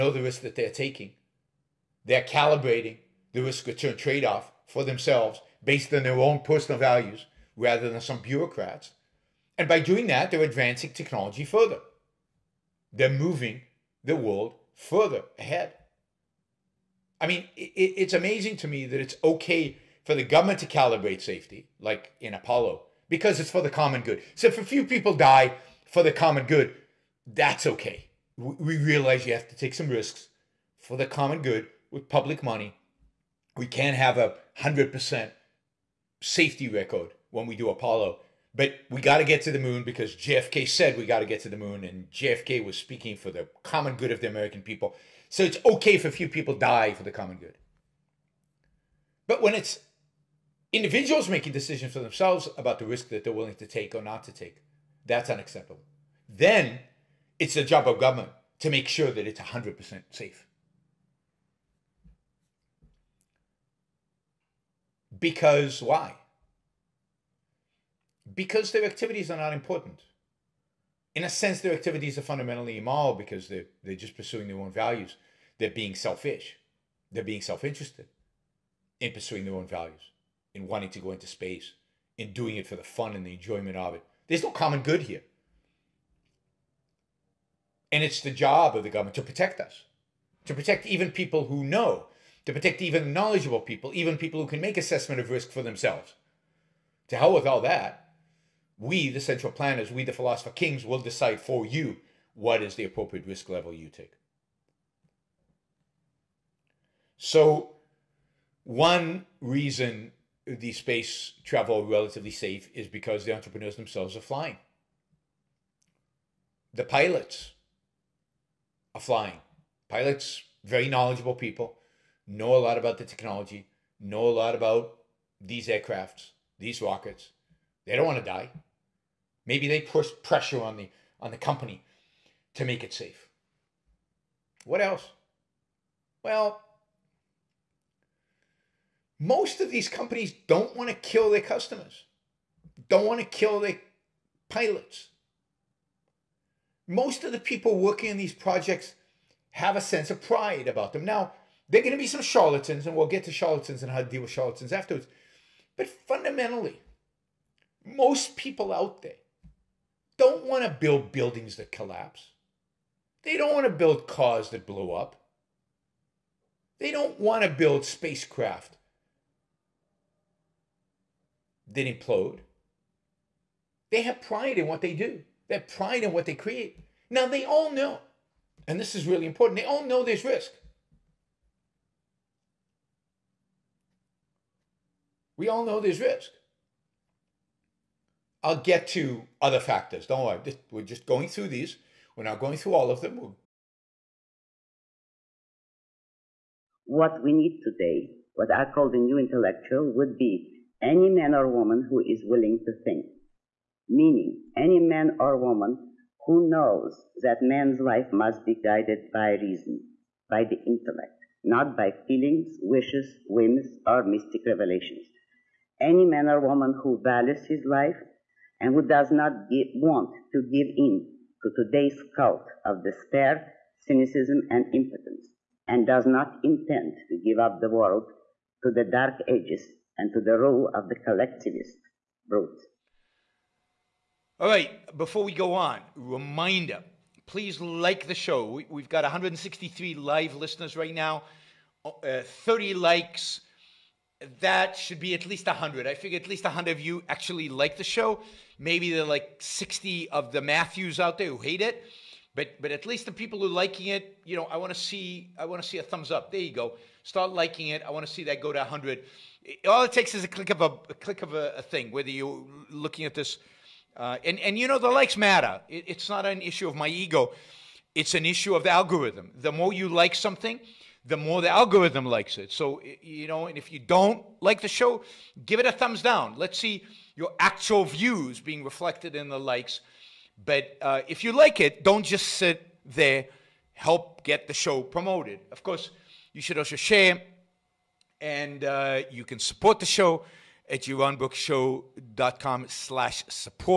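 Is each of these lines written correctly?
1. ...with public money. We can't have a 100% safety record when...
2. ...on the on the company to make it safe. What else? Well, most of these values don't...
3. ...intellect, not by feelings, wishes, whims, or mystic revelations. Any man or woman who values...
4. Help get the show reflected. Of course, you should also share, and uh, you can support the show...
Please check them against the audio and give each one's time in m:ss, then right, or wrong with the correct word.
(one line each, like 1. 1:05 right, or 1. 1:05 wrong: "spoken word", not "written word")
1. 0:31 right
2. 2:10 wrong: "companies", not "values"
3. 3:30 right
4. 4:43 wrong: "promoted", not "reflected".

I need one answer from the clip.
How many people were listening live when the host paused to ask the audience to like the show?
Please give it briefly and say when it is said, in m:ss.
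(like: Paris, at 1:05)
163, at 3:59.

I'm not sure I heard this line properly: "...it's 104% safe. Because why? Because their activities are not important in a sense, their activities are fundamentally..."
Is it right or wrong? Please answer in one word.
wrong.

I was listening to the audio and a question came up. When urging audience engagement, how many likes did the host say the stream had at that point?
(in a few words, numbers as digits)
30.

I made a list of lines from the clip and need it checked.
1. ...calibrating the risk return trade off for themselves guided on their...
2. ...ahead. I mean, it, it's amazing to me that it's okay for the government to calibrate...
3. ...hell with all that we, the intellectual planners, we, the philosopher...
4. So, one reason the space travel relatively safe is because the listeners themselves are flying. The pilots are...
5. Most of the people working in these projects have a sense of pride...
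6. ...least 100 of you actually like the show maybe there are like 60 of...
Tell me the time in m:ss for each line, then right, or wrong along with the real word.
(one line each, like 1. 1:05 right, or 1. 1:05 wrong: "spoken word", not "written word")
1. 0:02 wrong: "based", not "guided"
2. 0:15 right
3. 1:37 wrong: "central", not "intellectual"
4. 1:47 wrong: "entrepreneurs", not "listeners"
5. 2:26 right
6. 4:06 right.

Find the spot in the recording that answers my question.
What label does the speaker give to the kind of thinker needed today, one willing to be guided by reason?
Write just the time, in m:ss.
3:18.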